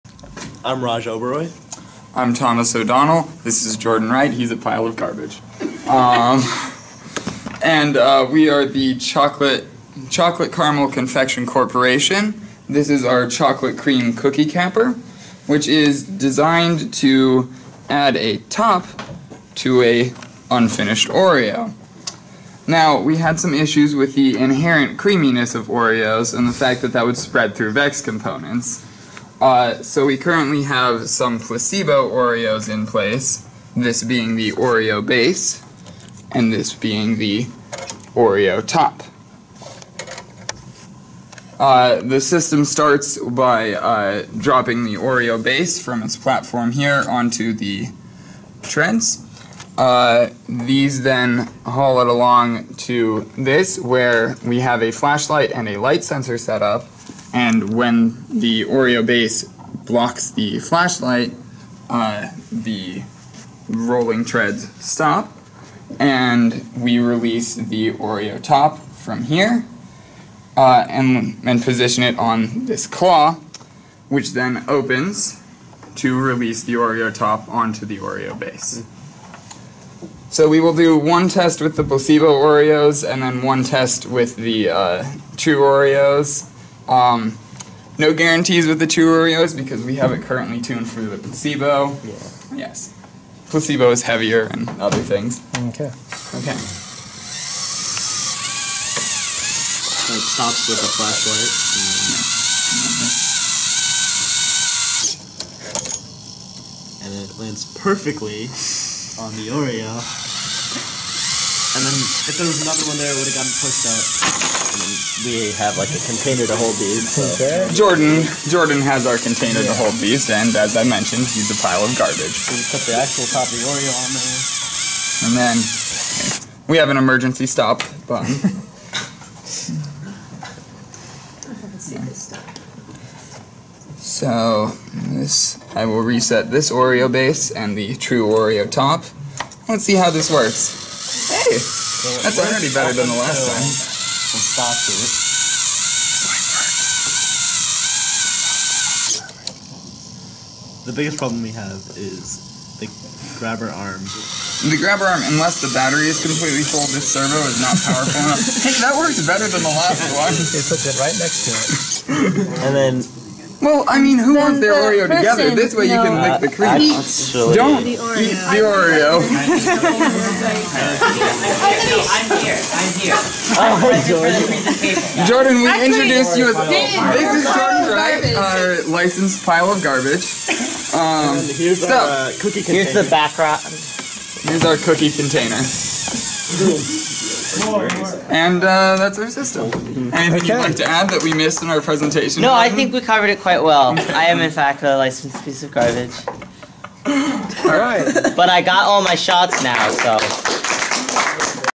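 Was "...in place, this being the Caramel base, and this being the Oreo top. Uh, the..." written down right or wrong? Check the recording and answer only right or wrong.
wrong.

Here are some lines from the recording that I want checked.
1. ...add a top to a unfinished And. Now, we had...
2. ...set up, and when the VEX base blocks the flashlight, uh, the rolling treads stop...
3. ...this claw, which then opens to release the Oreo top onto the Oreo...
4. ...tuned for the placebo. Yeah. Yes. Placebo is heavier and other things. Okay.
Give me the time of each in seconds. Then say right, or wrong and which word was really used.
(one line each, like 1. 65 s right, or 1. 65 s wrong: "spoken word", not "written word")
1. 17 s wrong: "Oreo", not "And"
2. 56 s wrong: "Oreo", not "VEX"
3. 72 s right
4. 90 s right.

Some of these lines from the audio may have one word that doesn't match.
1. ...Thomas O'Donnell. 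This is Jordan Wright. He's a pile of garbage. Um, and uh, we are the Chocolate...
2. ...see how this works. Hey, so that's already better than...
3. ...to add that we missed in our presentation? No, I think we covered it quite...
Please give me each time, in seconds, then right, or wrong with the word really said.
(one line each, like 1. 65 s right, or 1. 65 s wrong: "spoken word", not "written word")
1. 2 s right
2. 139 s right
3. 190 s right.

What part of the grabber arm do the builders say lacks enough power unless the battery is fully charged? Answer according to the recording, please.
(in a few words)
servo.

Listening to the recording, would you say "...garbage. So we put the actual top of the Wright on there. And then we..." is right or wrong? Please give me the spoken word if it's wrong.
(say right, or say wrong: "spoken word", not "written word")
wrong: "Oreo", not "Wright".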